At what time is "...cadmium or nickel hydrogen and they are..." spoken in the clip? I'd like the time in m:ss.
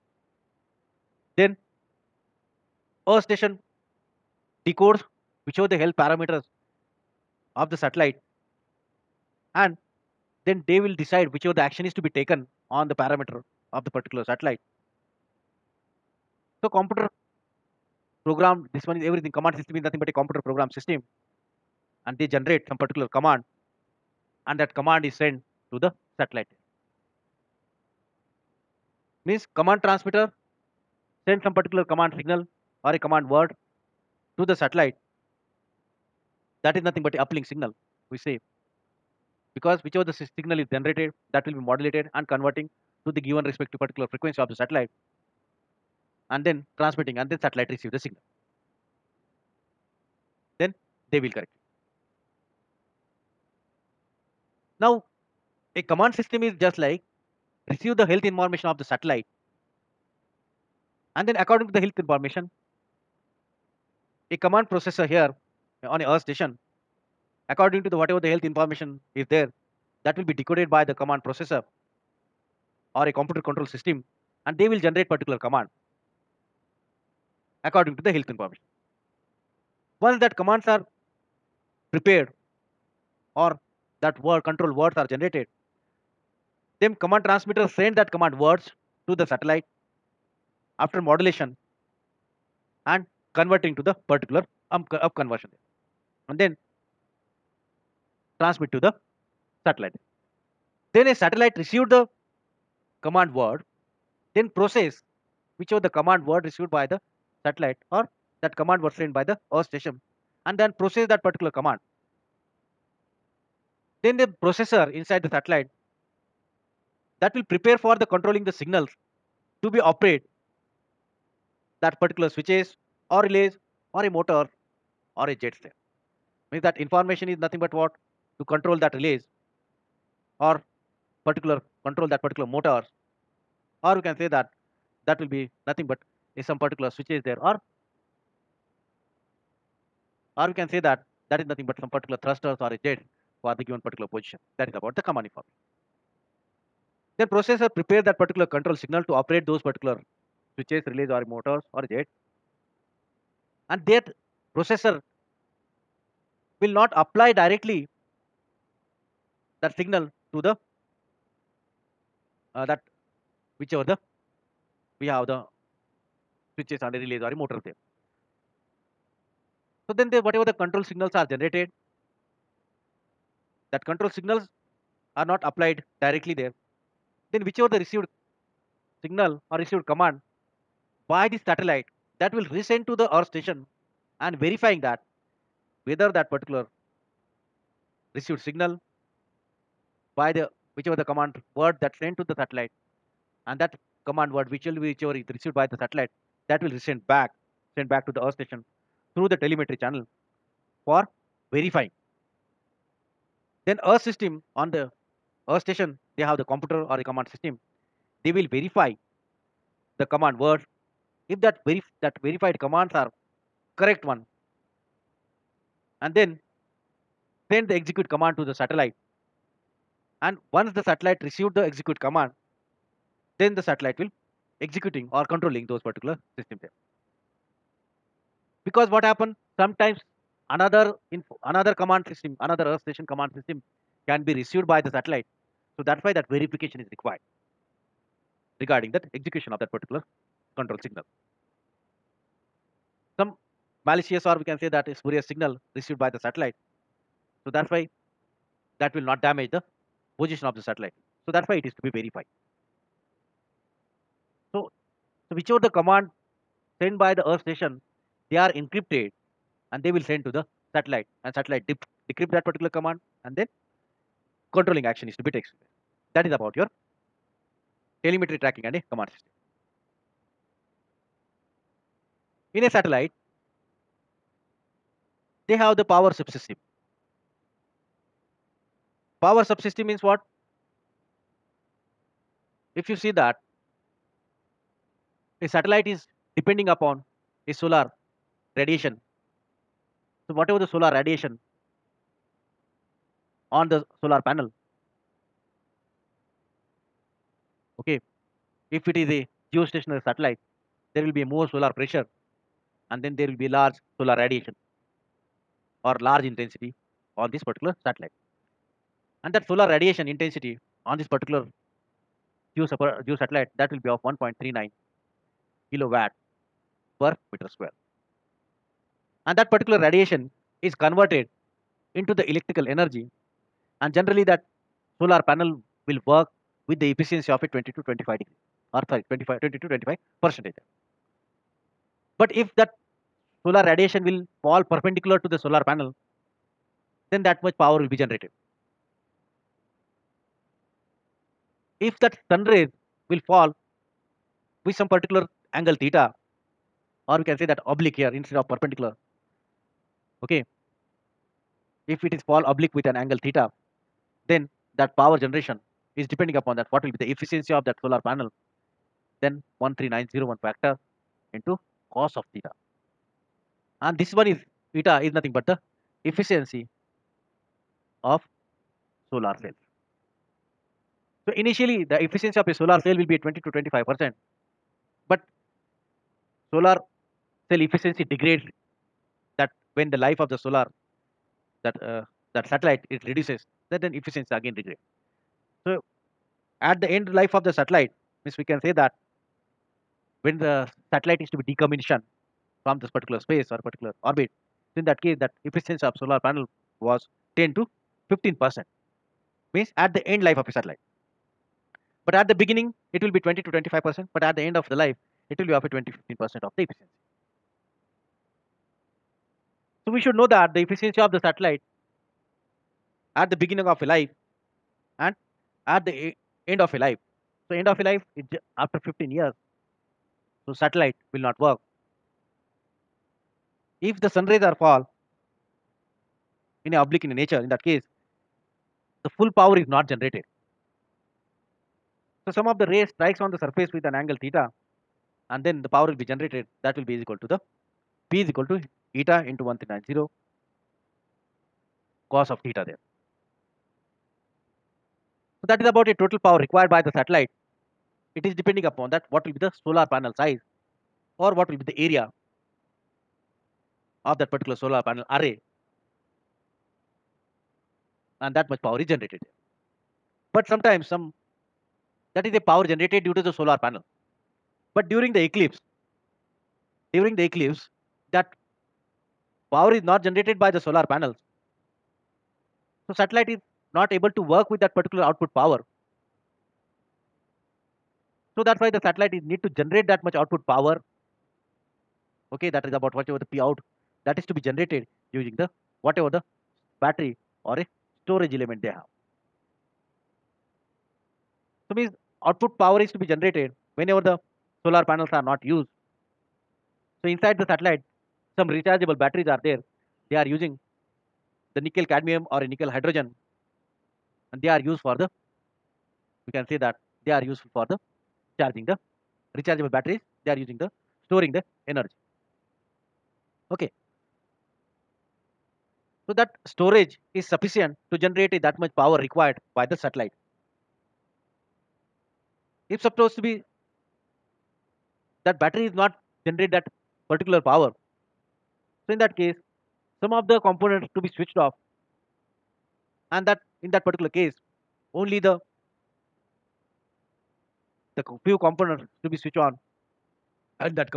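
8:21.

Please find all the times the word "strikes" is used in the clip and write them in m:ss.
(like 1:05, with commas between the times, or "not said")
7:12.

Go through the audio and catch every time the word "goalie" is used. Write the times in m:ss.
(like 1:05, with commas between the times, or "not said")
not said.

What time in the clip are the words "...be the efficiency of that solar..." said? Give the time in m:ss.
5:56.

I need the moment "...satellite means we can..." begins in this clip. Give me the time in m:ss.
6:27.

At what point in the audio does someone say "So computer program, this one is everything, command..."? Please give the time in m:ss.
0:16.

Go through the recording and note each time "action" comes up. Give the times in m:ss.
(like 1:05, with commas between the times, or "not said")
0:11, 4:24.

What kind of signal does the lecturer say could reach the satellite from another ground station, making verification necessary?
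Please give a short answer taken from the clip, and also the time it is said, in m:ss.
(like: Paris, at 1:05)
spurious signal, at 4:04.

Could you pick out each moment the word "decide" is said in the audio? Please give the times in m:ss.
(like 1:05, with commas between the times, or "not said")
0:11.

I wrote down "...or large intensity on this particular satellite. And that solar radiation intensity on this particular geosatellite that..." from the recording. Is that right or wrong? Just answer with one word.
right.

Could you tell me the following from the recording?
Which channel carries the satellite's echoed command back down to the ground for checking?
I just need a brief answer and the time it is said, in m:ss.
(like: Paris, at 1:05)
telemetry channel, at 3:19.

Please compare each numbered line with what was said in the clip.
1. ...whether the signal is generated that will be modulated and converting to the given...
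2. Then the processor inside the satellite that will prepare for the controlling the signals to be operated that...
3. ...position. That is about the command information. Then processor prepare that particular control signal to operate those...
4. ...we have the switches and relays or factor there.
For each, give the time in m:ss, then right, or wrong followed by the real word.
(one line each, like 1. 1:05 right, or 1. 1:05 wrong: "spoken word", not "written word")
1. 0:39 wrong: "whichever", not "whether"
2. 1:54 right
3. 2:24 right
4. 2:45 wrong: "motor", not "factor".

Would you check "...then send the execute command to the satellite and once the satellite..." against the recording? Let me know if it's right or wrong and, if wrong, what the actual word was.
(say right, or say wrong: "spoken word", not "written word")
right.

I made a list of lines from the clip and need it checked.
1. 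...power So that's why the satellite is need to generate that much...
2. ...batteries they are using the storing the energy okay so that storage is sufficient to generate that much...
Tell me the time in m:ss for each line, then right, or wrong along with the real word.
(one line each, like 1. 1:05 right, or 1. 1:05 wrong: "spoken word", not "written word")
1. 7:55 right
2. 8:29 right.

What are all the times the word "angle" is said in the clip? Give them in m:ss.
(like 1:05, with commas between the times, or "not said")
5:45, 5:53, 7:14.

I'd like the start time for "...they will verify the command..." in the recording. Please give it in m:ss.
3:28.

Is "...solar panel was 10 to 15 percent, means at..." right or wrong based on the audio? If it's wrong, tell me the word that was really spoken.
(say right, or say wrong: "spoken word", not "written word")
right.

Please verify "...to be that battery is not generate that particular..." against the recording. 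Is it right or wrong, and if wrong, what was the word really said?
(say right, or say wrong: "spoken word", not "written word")
right.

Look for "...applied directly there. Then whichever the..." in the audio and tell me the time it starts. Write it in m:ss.
2:55.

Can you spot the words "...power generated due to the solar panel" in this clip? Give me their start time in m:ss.
7:42.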